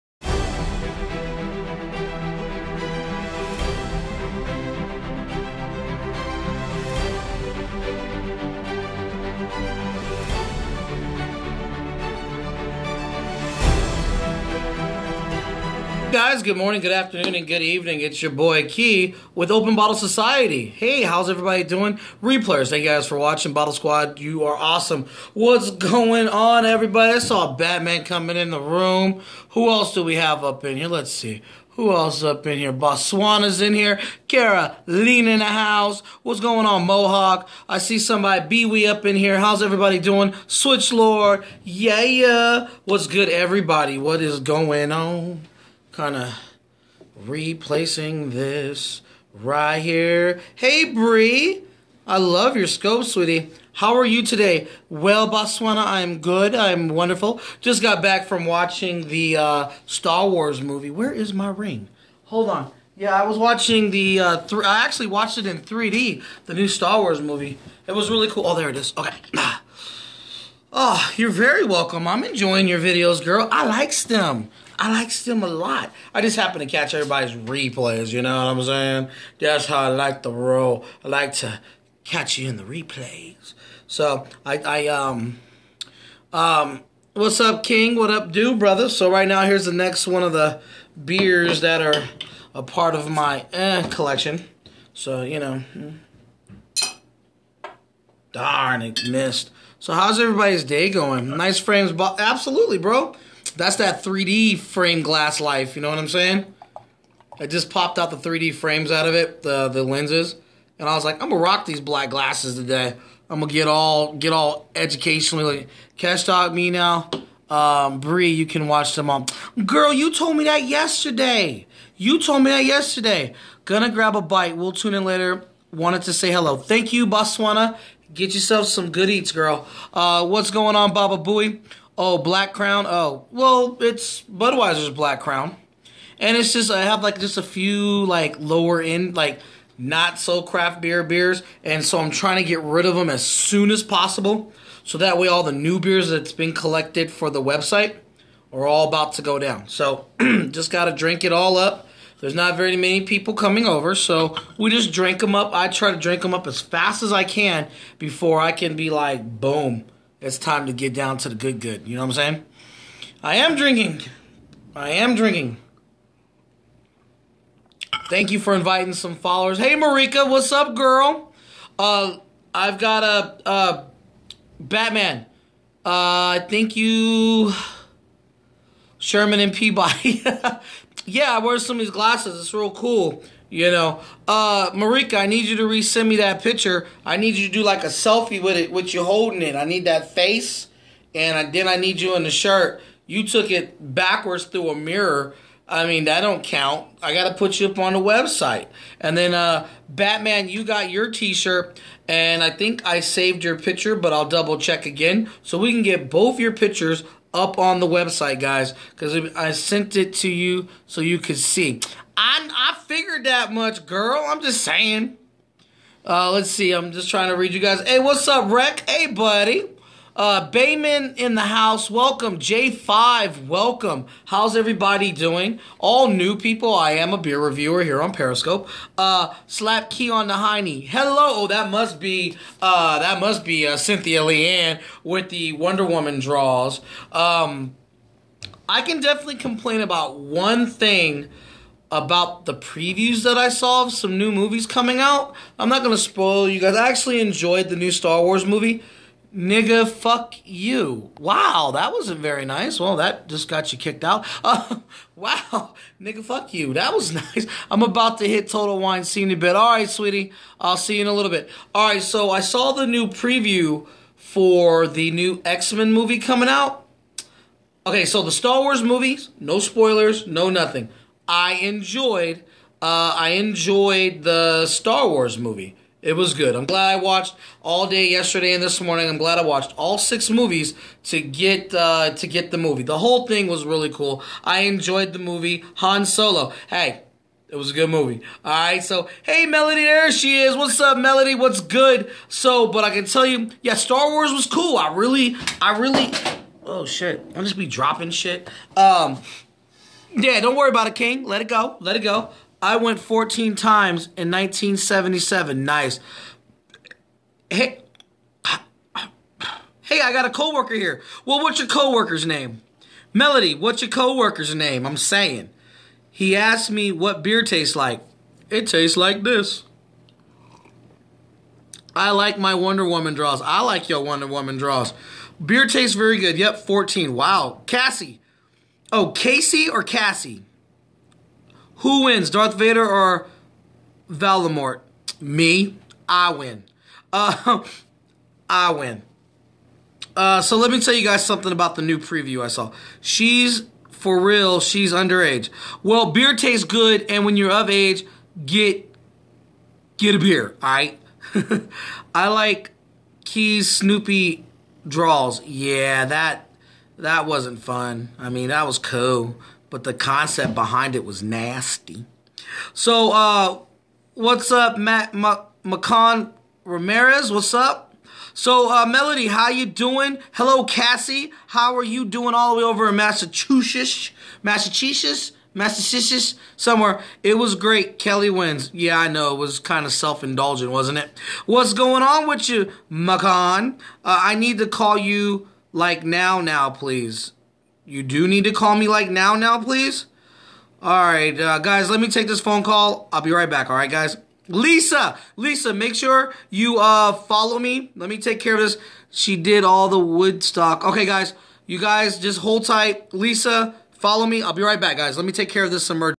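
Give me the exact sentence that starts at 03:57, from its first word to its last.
Um, I can definitely complain about one thing about the previews that I saw of some new movies coming out.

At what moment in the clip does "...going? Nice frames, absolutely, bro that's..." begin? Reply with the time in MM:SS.
01:40.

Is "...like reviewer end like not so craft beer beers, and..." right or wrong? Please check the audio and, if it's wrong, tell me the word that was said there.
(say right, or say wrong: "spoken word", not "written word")
wrong: "lower", not "reviewer".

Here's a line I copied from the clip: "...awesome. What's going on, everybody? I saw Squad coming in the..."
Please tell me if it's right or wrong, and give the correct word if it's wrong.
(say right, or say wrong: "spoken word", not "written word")
wrong: "Batman", not "Squad".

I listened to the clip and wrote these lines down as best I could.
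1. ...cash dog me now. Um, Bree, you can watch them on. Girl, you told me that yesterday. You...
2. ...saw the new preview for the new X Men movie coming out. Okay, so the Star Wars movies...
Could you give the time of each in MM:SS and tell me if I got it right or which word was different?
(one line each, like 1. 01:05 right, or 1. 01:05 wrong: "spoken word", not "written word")
1. 01:55 right
2. 04:22 right.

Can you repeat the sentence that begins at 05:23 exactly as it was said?
I like your Wonder Woman draws.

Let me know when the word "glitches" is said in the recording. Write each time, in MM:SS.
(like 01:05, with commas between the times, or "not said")
not said.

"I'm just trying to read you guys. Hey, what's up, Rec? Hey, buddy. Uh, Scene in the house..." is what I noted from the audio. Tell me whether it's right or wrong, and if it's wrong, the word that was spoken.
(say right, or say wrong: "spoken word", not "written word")
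wrong: "Bayman", not "Scene".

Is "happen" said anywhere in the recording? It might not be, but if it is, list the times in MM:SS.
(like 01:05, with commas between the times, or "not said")
01:16.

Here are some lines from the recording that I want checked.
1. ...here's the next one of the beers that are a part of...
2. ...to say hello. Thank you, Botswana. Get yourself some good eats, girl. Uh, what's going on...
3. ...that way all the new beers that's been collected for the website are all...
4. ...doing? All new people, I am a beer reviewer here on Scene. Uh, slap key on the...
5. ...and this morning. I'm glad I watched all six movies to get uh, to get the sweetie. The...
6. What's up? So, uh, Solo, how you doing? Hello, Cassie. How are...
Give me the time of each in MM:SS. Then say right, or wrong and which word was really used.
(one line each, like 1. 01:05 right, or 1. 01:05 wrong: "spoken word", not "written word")
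1. 01:29 right
2. 02:06 right
3. 02:24 right
4. 03:45 wrong: "Periscope", not "Scene"
5. 04:38 wrong: "movie", not "sweetie"
6. 06:07 wrong: "Melody", not "Solo".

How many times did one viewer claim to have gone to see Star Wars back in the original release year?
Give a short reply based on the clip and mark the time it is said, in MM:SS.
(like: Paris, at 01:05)
14, at 05:02.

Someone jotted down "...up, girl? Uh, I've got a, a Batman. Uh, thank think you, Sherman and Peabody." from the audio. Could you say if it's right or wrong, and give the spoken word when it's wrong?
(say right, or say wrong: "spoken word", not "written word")
right.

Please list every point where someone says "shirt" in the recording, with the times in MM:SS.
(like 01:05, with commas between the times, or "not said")
03:12, 03:21.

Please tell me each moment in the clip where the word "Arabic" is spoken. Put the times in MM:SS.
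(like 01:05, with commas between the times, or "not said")
not said.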